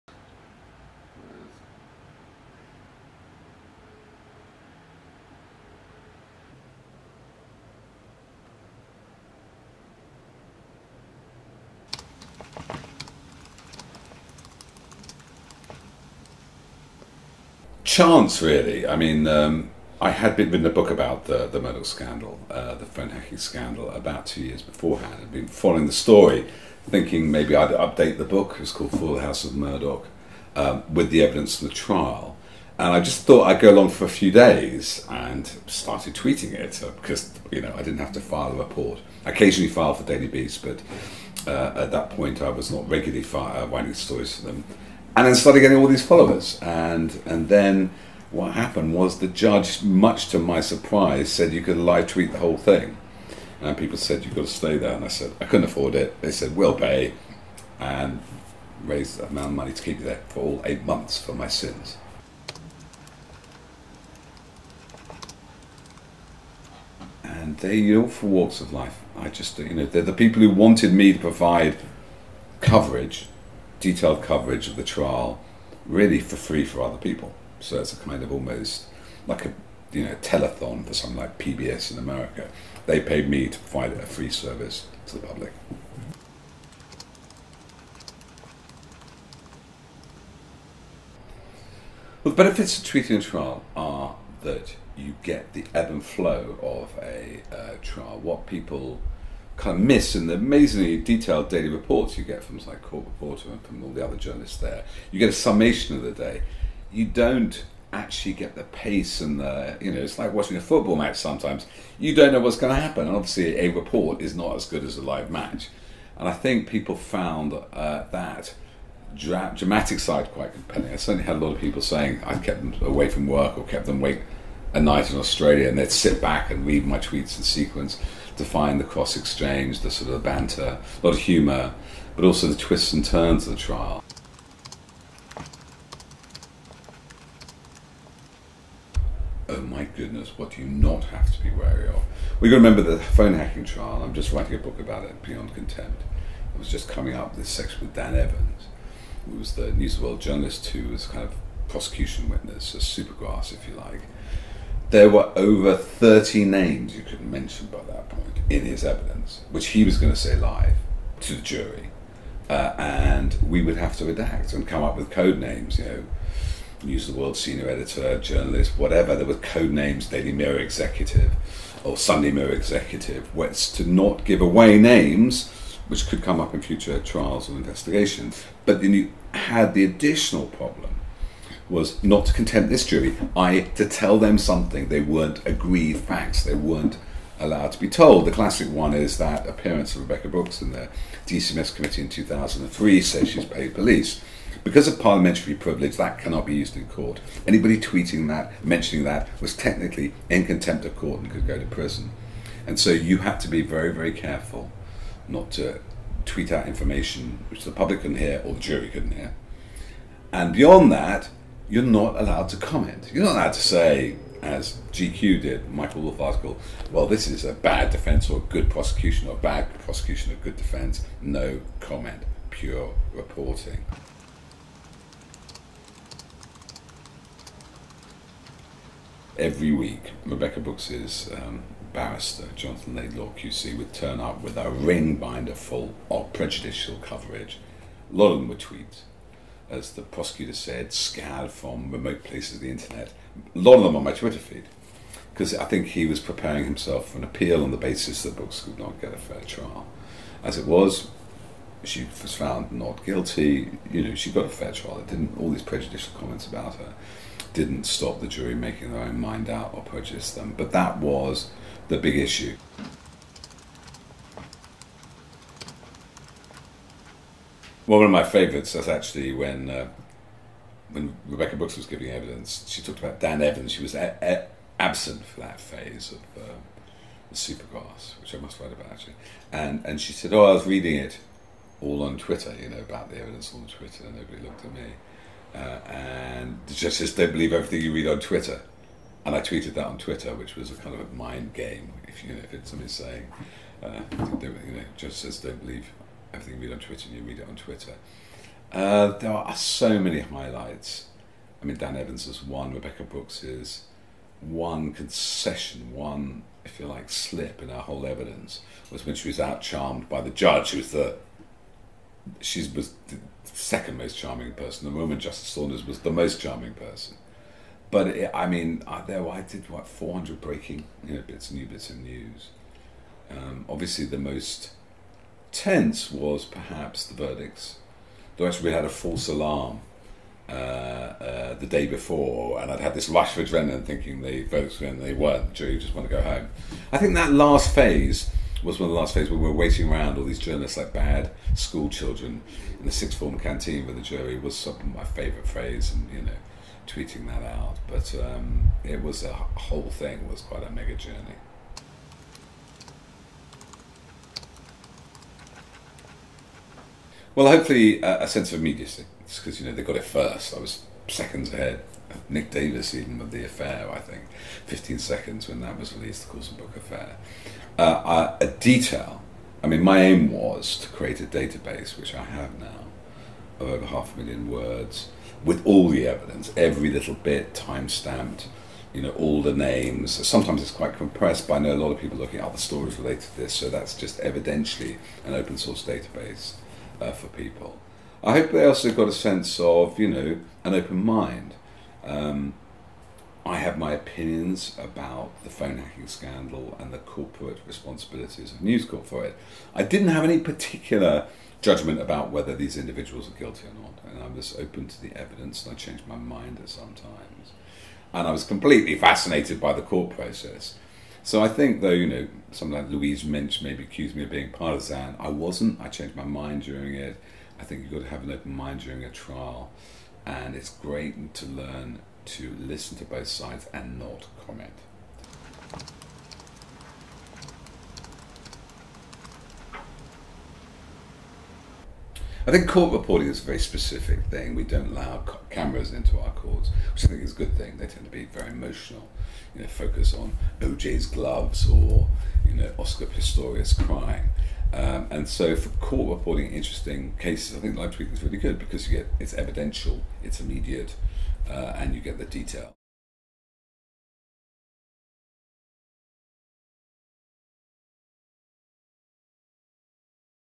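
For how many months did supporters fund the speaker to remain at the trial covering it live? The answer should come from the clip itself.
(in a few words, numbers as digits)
8.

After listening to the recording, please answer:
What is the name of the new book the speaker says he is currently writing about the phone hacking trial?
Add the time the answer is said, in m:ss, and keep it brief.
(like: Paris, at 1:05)
Beyond Contempt, at 2:25.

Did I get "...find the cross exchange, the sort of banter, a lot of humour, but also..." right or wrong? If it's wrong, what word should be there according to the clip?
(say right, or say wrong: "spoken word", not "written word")
right.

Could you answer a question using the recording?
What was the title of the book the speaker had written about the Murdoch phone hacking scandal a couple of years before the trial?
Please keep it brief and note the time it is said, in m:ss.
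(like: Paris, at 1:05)
Full House of Murdoch, at 0:28.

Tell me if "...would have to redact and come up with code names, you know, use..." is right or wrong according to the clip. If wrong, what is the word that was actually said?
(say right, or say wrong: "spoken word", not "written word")
right.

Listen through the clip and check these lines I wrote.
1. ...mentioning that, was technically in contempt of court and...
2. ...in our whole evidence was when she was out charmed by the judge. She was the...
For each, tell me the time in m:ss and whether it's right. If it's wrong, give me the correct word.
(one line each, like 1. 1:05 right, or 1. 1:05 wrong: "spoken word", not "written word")
1. 3:18 right
2. 5:07 right.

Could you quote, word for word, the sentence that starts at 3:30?
And beyond that, you're not allowed to comment.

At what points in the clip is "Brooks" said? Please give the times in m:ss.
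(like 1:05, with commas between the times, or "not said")
3:10, 3:50, 4:08, 4:31, 5:03, 6:06.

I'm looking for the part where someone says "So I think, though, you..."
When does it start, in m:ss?
6:51.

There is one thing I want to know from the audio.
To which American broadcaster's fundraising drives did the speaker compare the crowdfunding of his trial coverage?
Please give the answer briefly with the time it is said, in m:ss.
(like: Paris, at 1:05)
PBS, at 1:21.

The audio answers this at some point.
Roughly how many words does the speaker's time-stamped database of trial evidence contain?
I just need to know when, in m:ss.
6:13.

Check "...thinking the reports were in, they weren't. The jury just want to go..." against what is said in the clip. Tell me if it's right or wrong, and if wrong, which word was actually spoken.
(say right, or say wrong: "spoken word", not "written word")
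wrong: "verdicts", not "reports".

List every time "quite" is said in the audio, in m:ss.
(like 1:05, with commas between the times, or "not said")
2:00, 5:50, 6:20.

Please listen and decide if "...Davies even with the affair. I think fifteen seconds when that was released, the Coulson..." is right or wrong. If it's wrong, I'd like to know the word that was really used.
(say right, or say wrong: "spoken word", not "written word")
right.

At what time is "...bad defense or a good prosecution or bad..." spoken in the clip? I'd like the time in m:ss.
3:37.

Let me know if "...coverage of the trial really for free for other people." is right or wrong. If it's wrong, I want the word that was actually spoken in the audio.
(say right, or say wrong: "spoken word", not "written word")
right.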